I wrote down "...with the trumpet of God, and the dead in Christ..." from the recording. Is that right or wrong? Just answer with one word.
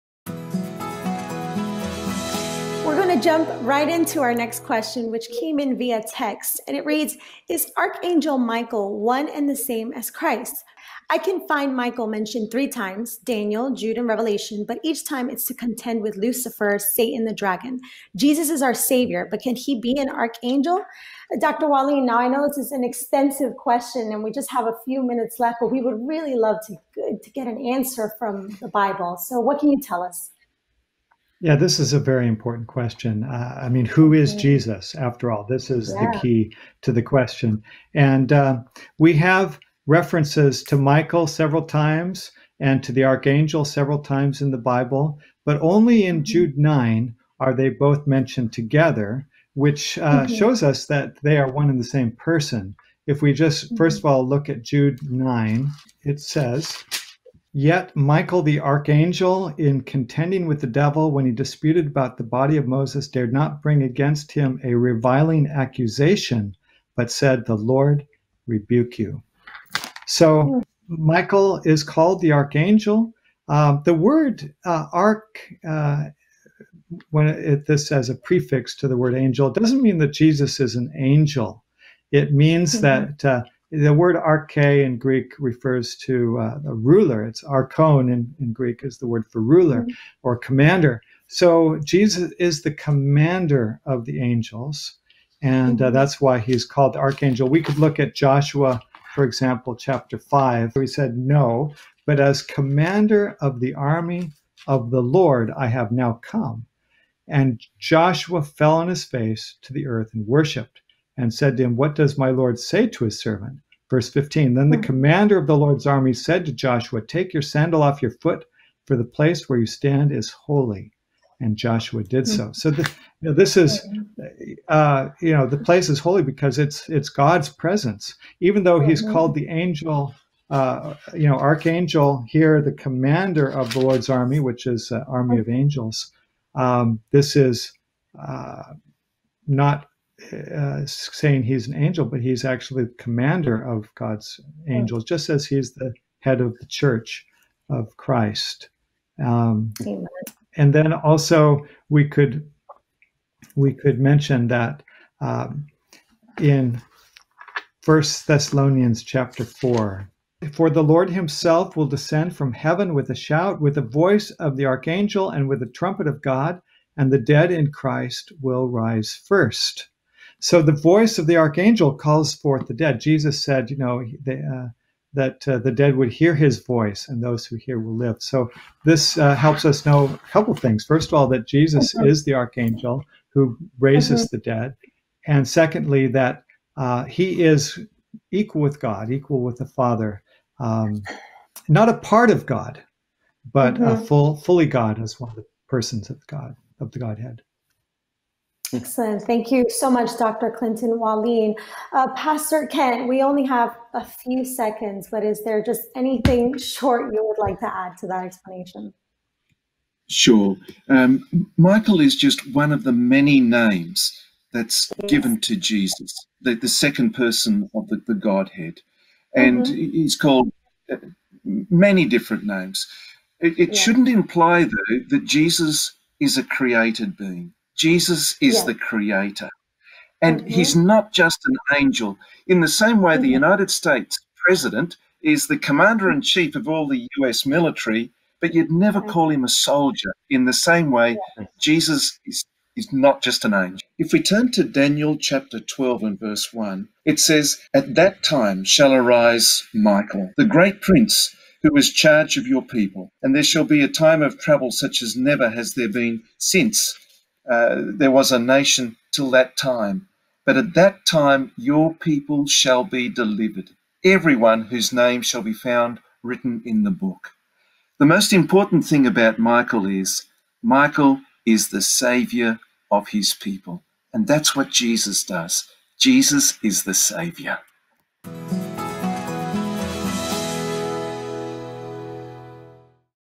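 right.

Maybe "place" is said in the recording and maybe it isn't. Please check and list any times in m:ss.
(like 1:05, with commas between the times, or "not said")
1:59, 2:05.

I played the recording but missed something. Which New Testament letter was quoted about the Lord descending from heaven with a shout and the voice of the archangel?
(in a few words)
First Thessalonians.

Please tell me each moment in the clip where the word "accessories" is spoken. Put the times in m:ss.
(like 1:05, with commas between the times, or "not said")
not said.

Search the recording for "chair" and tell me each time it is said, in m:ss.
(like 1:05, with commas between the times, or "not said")
not said.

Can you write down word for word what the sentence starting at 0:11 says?
I can find Michael mentioned three times Daniel, Jude, and Revelation, but each time it's to contend with Lucifer, Satan, the dragon.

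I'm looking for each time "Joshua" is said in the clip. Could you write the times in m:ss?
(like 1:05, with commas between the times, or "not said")
1:38, 1:47, 1:56, 2:01.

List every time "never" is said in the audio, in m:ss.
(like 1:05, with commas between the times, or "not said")
3:58, 4:15.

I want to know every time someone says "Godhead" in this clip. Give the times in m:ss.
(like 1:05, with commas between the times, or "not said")
3:16, 3:38.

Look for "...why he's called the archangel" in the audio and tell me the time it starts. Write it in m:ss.
1:36.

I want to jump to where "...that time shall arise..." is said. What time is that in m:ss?
4:07.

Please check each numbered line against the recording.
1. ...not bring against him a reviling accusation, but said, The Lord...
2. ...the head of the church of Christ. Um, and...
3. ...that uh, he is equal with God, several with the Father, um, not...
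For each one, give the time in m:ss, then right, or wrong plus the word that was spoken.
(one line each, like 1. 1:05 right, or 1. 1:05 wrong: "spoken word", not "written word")
1. 1:03 right
2. 2:25 right
3. 3:06 wrong: "equal", not "several".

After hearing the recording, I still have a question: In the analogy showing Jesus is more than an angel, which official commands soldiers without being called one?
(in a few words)
United States president.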